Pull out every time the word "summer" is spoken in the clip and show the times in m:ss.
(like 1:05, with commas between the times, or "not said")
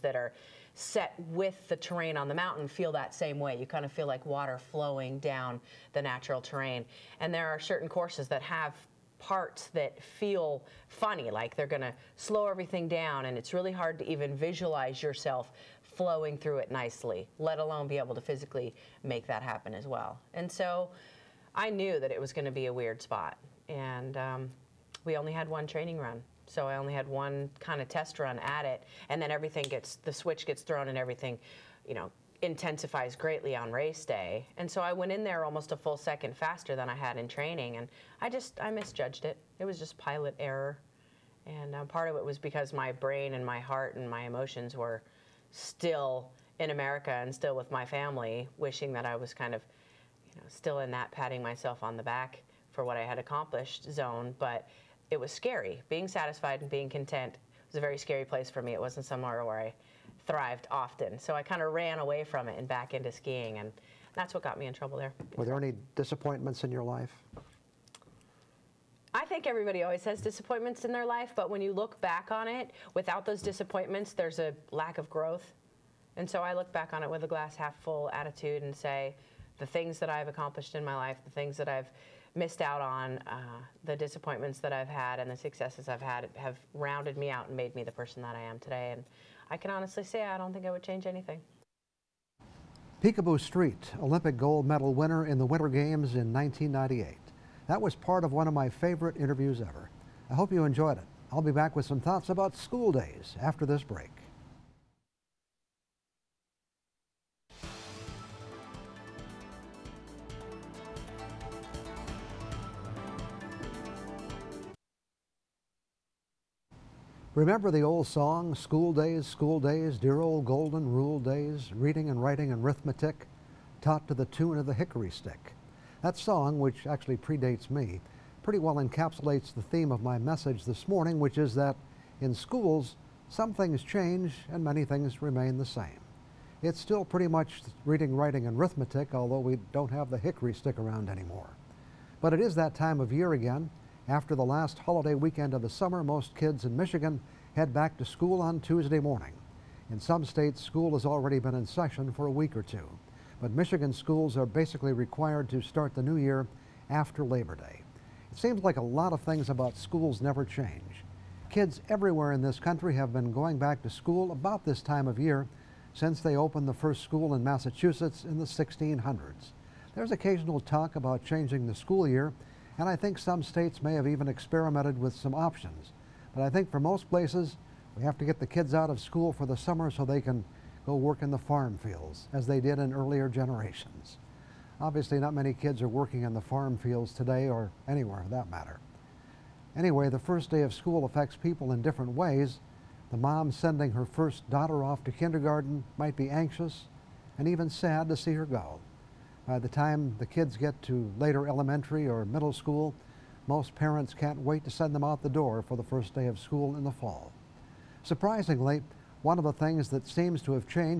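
2:25, 2:59.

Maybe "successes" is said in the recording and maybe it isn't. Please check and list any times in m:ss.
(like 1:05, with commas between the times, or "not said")
1:25.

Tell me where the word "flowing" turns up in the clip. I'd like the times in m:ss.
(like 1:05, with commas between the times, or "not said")
0:04, 0:15.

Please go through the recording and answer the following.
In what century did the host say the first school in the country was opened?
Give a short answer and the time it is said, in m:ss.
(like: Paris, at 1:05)
1600s, at 2:48.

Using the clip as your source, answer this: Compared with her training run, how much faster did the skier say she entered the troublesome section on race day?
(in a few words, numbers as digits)
almost a full second.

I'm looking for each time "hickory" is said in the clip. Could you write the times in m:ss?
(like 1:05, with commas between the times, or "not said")
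2:04, 2:20.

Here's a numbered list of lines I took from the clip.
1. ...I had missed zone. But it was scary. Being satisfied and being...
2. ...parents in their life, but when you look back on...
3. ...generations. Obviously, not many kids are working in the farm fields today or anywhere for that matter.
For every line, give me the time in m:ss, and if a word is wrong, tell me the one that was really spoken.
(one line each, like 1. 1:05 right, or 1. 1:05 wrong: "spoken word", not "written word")
1. 0:52 wrong: "accomplished", not "missed"
2. 1:10 wrong: "disappointments", not "parents"
3. 3:03 right.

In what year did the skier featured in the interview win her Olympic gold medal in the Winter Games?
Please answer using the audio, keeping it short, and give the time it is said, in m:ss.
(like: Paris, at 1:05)
1998, at 1:36.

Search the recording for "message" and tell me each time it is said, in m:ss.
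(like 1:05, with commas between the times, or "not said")
2:10.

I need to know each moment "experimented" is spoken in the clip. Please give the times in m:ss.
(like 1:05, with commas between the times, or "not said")
2:54.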